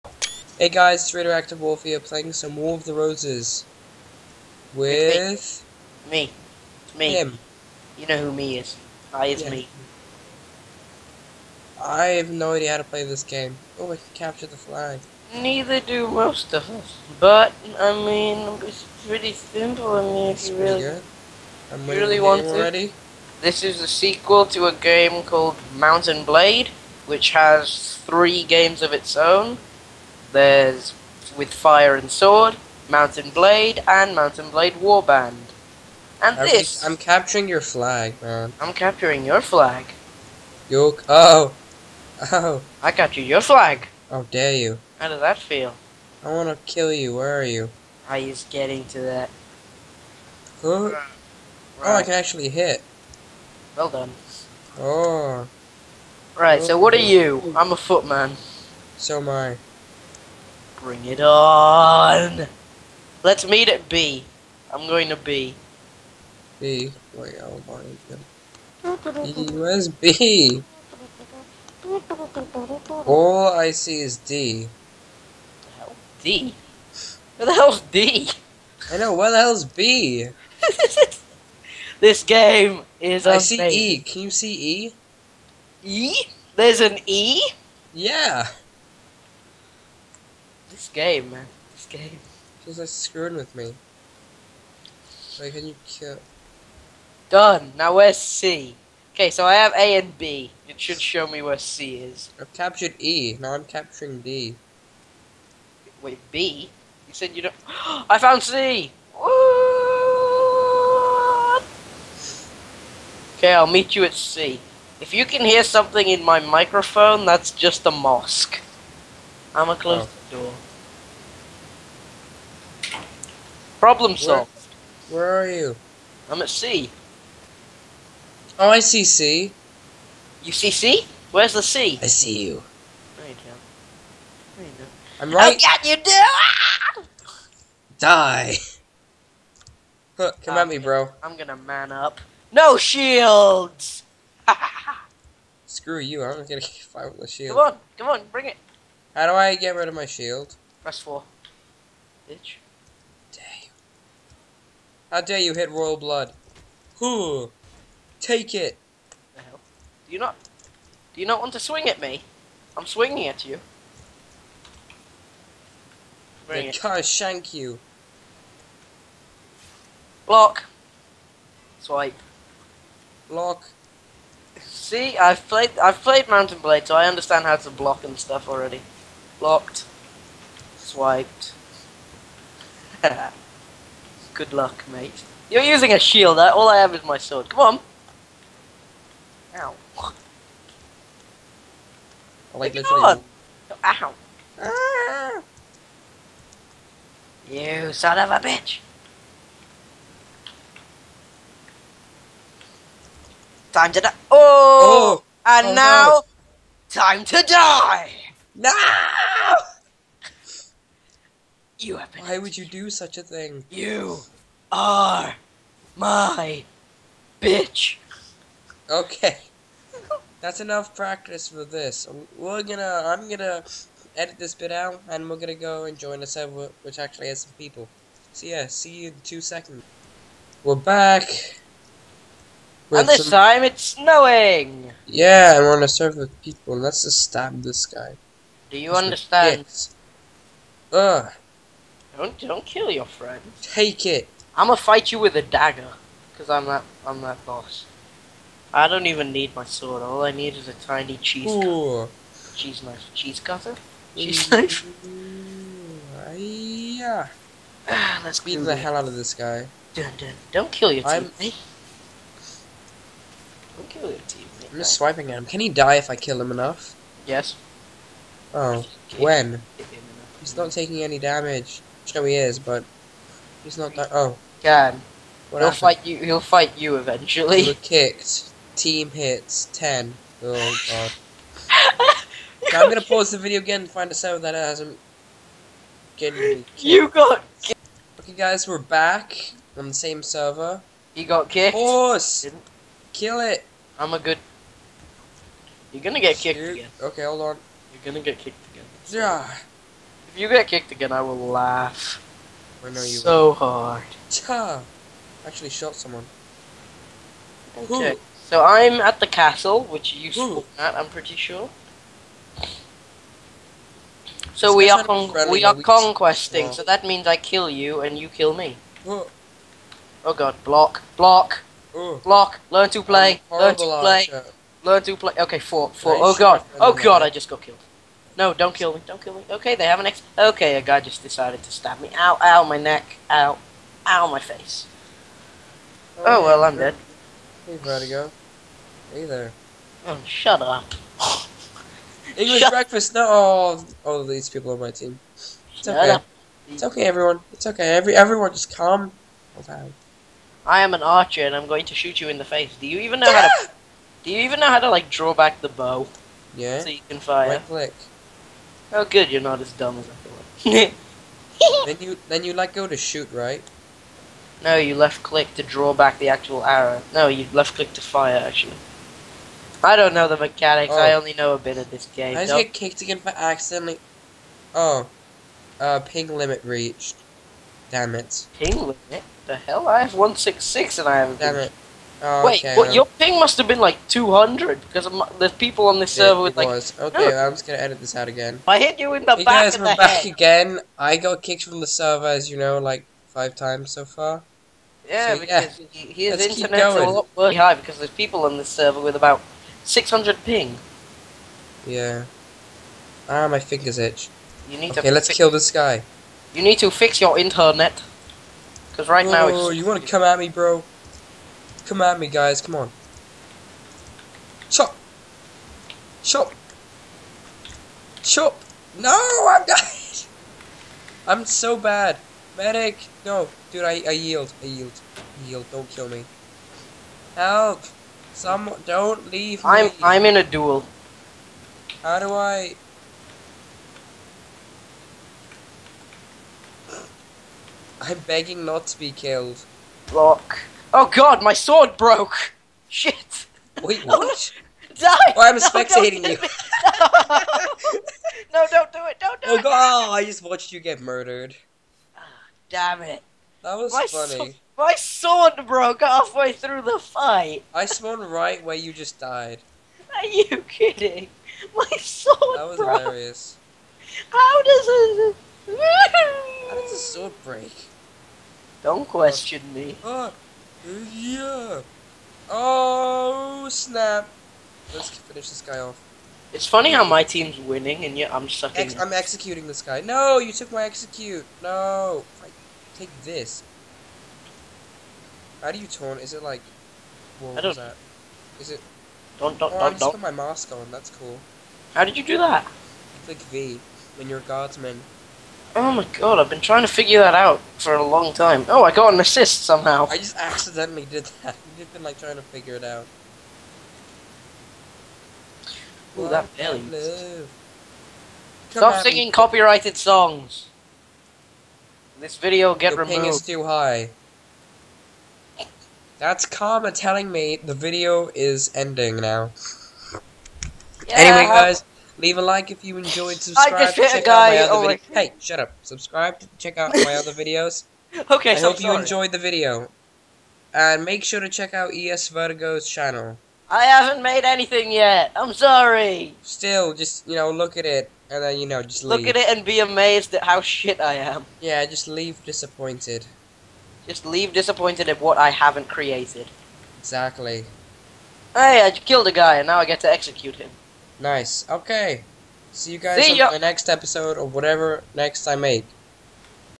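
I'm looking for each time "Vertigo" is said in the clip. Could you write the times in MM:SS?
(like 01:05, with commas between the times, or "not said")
05:37, 08:52.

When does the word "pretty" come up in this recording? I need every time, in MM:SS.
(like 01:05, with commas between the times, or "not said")
00:19, 05:11.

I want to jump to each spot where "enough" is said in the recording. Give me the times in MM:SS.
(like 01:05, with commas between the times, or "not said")
03:40, 04:26.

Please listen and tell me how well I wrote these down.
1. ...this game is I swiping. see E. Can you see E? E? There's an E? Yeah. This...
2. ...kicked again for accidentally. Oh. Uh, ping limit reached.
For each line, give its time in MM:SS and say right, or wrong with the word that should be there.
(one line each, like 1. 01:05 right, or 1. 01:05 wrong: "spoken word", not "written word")
1. 01:21 wrong: "amazing", not "swiping"
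2. 06:12 right.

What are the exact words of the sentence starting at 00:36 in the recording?
We, I'm capturing your flag, man.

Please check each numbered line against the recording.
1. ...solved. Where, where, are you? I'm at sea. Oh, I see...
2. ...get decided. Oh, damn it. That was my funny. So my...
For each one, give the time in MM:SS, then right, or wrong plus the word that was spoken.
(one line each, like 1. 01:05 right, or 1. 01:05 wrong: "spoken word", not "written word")
1. 02:04 right
2. 07:30 wrong: "murdered", not "decided".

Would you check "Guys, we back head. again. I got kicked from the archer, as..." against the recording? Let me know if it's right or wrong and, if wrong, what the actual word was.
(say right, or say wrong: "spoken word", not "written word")
wrong: "server", not "archer".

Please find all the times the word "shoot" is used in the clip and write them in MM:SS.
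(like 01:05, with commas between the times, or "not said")
04:56, 05:51, 06:02.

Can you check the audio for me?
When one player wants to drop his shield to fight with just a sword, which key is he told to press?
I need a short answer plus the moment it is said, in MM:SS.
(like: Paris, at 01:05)
4, at 02:30.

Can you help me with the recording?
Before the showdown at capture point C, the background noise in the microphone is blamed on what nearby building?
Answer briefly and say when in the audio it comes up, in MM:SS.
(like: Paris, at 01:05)
A mosque, at 01:57.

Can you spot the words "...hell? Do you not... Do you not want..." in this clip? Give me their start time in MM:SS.
02:39.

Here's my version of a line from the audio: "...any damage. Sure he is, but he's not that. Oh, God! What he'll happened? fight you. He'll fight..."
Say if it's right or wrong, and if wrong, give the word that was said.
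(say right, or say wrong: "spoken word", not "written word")
right.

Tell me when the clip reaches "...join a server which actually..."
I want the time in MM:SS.
03:45.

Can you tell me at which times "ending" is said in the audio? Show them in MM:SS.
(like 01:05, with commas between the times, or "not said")
08:38.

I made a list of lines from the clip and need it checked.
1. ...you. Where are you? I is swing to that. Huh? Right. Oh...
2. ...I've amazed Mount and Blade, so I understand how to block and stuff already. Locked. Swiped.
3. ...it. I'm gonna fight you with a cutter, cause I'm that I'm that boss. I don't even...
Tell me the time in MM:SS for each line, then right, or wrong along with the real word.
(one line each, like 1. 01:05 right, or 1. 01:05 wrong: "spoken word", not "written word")
1. 00:46 wrong: "getting", not "swing"
2. 02:55 wrong: "played", not "amazed"
3. 04:04 wrong: "dagger", not "cutter".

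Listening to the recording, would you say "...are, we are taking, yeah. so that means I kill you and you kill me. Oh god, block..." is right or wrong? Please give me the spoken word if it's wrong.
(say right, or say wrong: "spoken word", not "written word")
wrong: "conquesting", not "taking".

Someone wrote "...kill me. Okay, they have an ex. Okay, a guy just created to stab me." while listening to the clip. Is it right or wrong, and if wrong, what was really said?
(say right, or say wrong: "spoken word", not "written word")
wrong: "decided", not "created".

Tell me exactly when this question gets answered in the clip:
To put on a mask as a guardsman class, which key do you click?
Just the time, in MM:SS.
08:13.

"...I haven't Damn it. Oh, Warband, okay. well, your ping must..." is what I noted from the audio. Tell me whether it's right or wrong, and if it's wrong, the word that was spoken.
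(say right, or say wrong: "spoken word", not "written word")
wrong: "Wait", not "Warband".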